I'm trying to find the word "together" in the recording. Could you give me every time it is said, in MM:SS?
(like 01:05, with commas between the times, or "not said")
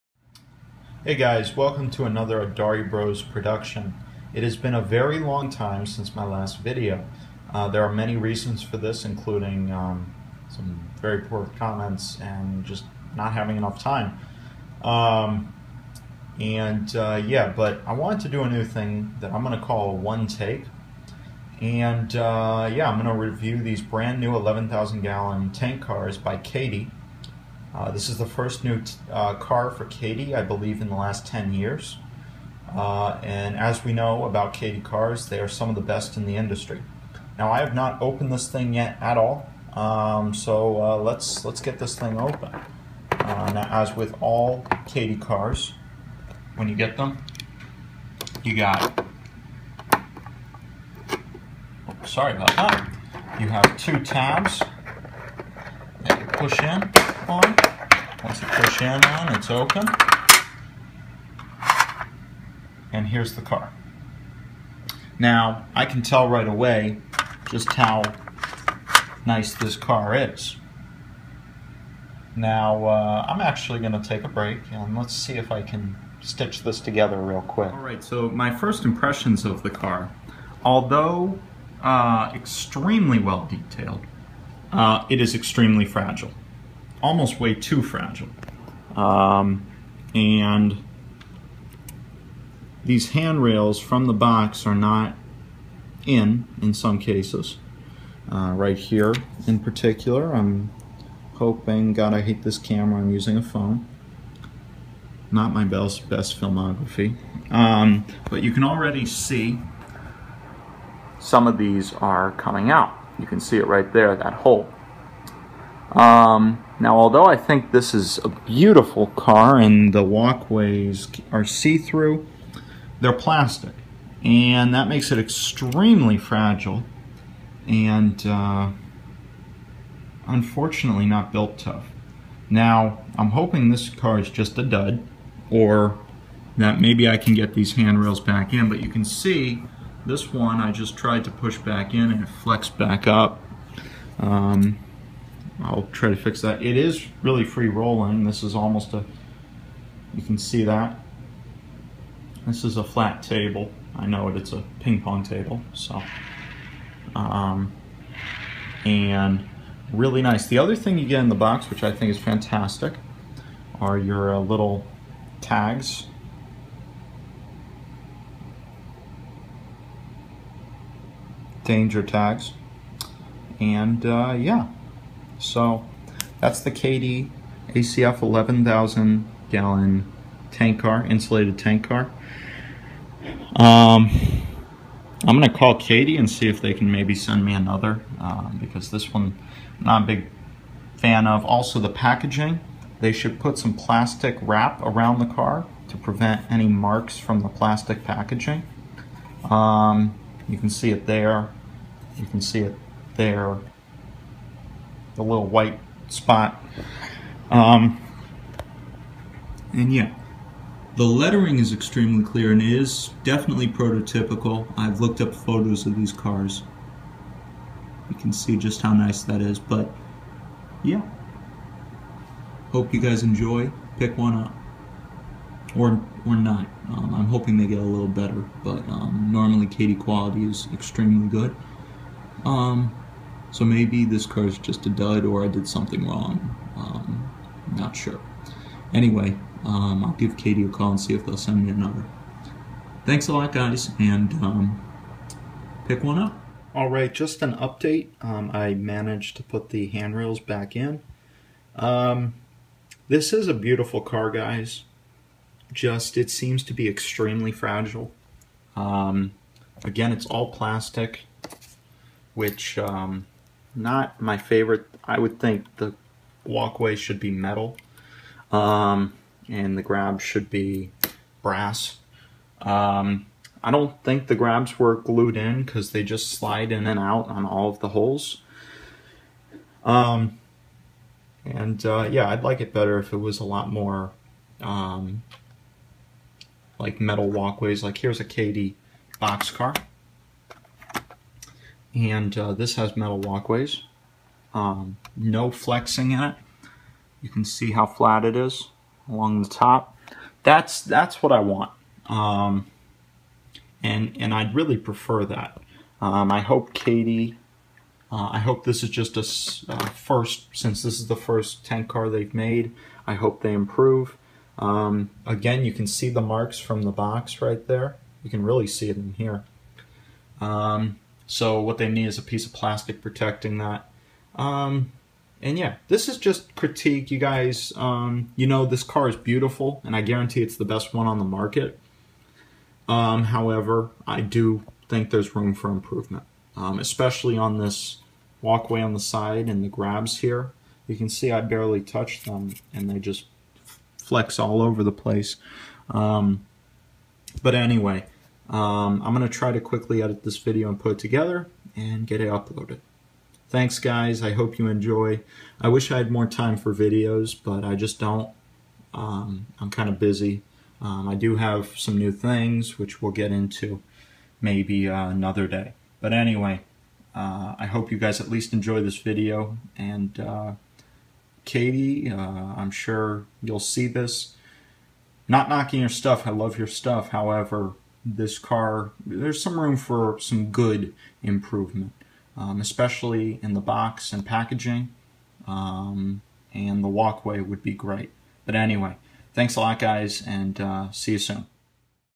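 01:16, 05:50.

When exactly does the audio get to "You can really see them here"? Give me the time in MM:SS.
05:18.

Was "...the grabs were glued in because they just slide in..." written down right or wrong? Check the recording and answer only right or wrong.
right.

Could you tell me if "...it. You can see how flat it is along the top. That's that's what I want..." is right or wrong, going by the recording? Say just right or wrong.
right.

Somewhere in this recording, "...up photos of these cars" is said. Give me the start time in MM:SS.
03:35.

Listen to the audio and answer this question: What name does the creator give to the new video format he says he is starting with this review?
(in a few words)
One Take.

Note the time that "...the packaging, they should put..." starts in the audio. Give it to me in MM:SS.
03:11.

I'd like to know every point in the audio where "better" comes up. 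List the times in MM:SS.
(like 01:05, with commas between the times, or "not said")
03:48, 04:42.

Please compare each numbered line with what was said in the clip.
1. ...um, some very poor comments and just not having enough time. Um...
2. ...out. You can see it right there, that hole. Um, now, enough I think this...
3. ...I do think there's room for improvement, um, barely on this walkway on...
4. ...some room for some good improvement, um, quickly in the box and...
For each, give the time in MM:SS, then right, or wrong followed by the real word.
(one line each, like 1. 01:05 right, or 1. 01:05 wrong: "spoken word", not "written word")
1. 00:09 right
2. 01:52 wrong: "although", not "enough"
3. 05:34 wrong: "especially", not "barely"
4. 06:19 wrong: "especially", not "quickly".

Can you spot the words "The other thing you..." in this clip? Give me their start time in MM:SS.
02:40.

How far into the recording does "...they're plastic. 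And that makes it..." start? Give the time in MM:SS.
02:02.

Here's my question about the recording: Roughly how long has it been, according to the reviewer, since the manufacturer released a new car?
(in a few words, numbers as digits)
10 years.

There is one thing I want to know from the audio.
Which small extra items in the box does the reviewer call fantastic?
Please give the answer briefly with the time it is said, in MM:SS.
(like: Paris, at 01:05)
Danger tags, at 02:51.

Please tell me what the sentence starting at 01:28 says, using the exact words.
Um, and these handrails from the box are not in, in some cases.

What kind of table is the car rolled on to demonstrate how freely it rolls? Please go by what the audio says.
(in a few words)
ping pong table.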